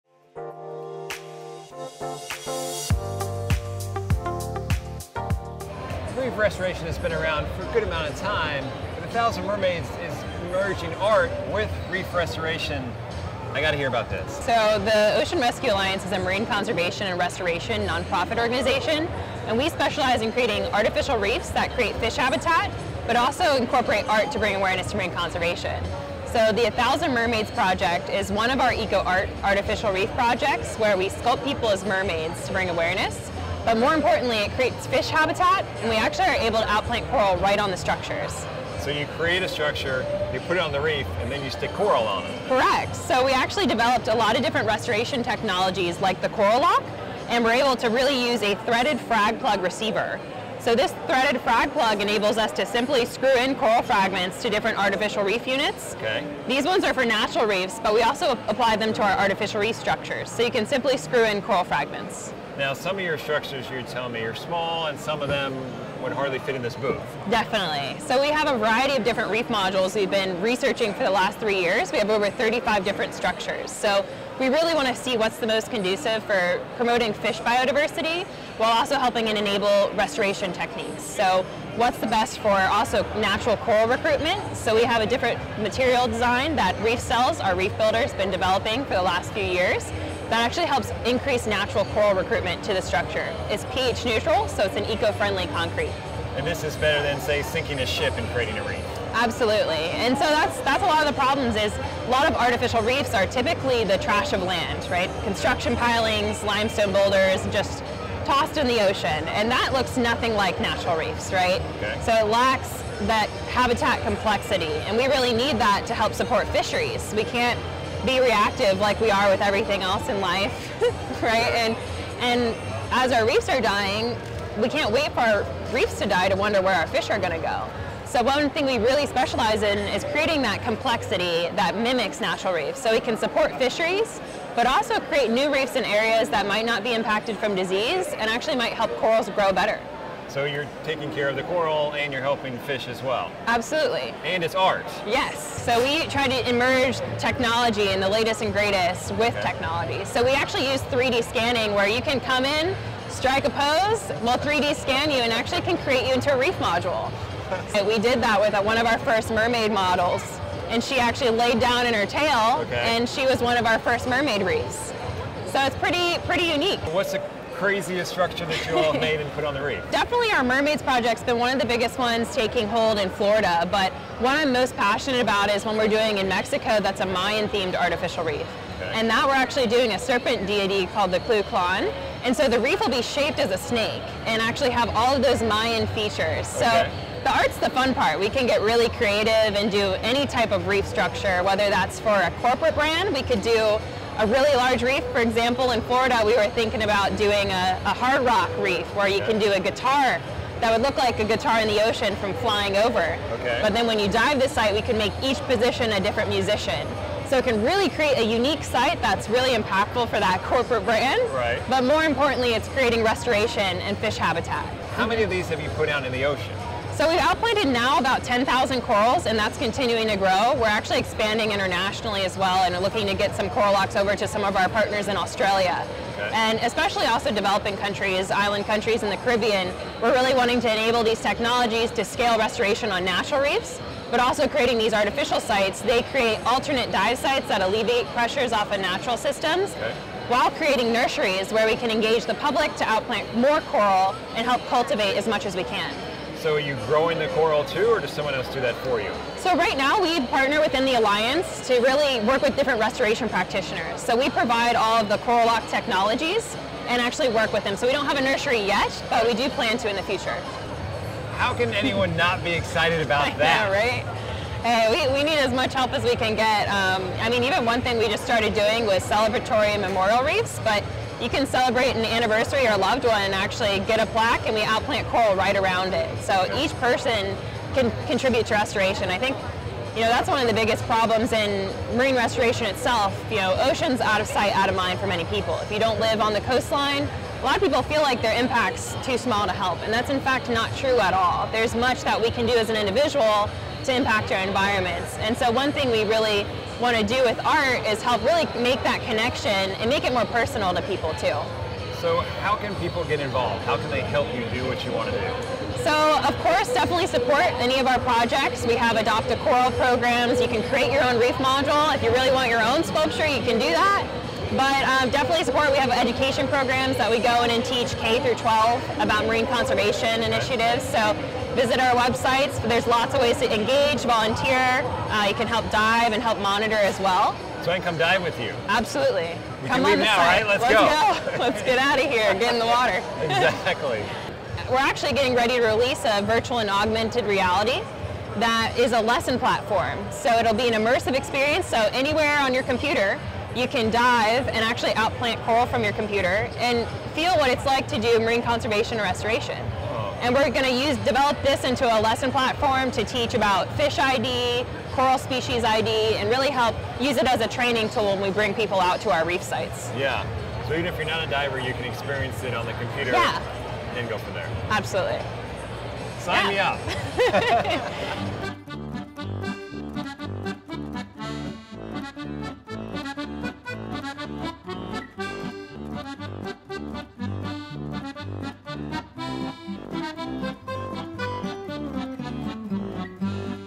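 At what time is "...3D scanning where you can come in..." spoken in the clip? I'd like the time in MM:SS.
02:30.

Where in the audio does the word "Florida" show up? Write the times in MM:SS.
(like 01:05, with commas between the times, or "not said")
02:53, 03:15.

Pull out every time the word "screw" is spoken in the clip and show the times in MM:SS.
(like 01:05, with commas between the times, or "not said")
00:53, 01:00.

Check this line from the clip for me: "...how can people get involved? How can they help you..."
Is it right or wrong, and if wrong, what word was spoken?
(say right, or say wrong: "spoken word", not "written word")
right.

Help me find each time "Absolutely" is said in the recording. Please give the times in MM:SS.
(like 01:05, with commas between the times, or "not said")
01:39, 02:23, 05:28, 06:04.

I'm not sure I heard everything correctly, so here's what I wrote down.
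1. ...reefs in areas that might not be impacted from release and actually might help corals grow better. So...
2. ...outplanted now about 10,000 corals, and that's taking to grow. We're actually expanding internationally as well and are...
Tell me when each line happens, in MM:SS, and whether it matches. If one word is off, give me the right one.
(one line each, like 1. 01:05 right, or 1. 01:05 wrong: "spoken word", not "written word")
1. 02:15 wrong: "disease", not "release"
2. 03:37 wrong: "continuing", not "taking".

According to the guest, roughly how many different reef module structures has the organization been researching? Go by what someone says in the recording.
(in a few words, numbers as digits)
35.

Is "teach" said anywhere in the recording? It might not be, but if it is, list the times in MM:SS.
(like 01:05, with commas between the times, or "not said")
05:17, 05:53.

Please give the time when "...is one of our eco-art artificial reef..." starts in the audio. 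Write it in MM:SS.
00:28.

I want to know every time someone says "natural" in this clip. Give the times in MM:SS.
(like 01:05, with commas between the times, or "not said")
00:57, 01:23, 01:31, 01:50, 02:12, 03:53, 03:58.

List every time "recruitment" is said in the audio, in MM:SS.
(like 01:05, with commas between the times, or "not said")
01:23, 01:32.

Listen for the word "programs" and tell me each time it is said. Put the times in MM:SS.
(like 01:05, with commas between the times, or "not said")
05:09, 05:16.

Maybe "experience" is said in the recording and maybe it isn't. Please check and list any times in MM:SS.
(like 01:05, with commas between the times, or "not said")
05:41, 06:01.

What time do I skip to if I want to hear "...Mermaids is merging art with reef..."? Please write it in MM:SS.
00:09.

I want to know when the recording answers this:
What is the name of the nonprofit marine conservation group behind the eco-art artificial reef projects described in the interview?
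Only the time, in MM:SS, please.
00:15.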